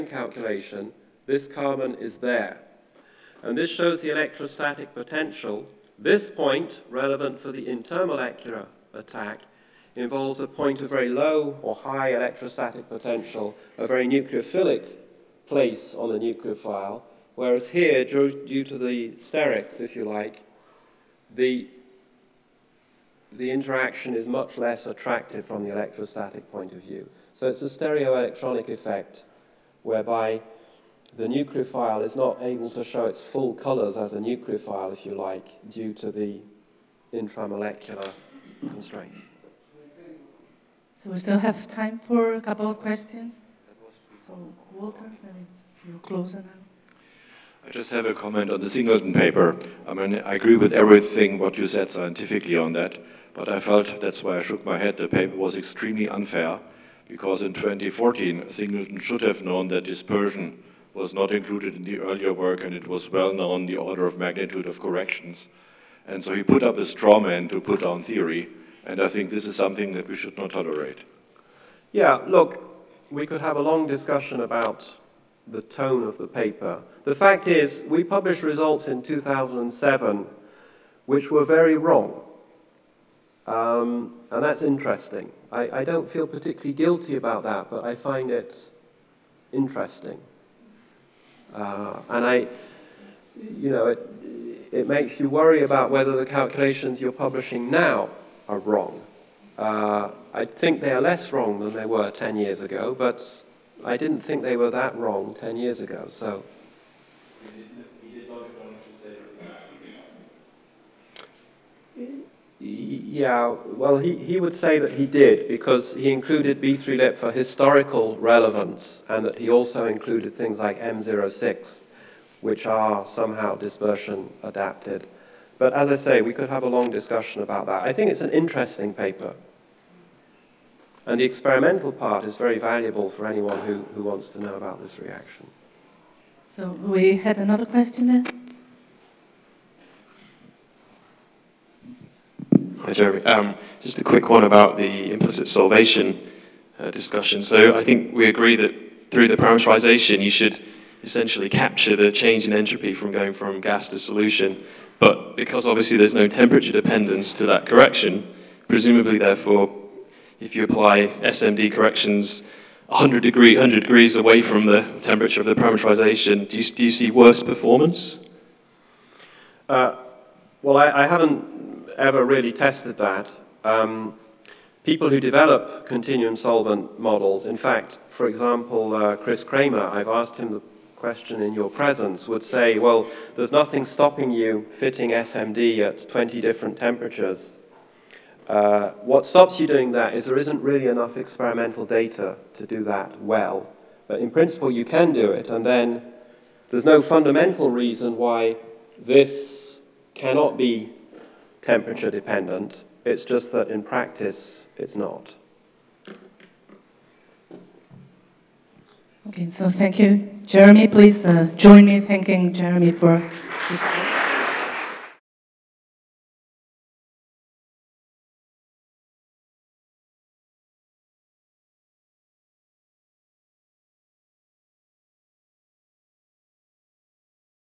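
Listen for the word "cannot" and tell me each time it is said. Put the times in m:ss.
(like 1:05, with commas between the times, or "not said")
3:20.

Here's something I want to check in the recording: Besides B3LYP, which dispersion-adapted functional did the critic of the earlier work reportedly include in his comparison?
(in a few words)
M06.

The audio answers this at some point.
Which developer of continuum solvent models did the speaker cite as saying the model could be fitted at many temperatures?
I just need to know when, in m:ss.
2:59.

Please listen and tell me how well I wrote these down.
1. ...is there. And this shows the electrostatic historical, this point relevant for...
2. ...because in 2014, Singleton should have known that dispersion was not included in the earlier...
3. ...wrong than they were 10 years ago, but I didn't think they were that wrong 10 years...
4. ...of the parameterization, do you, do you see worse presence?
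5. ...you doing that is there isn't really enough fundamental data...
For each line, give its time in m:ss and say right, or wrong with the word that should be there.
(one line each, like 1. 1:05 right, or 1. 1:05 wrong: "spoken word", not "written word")
1. 0:01 wrong: "potential", not "historical"
2. 0:57 right
3. 1:41 right
4. 2:45 wrong: "performance", not "presence"
5. 3:09 wrong: "experimental", not "fundamental".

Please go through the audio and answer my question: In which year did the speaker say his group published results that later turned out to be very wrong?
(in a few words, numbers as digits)
2007.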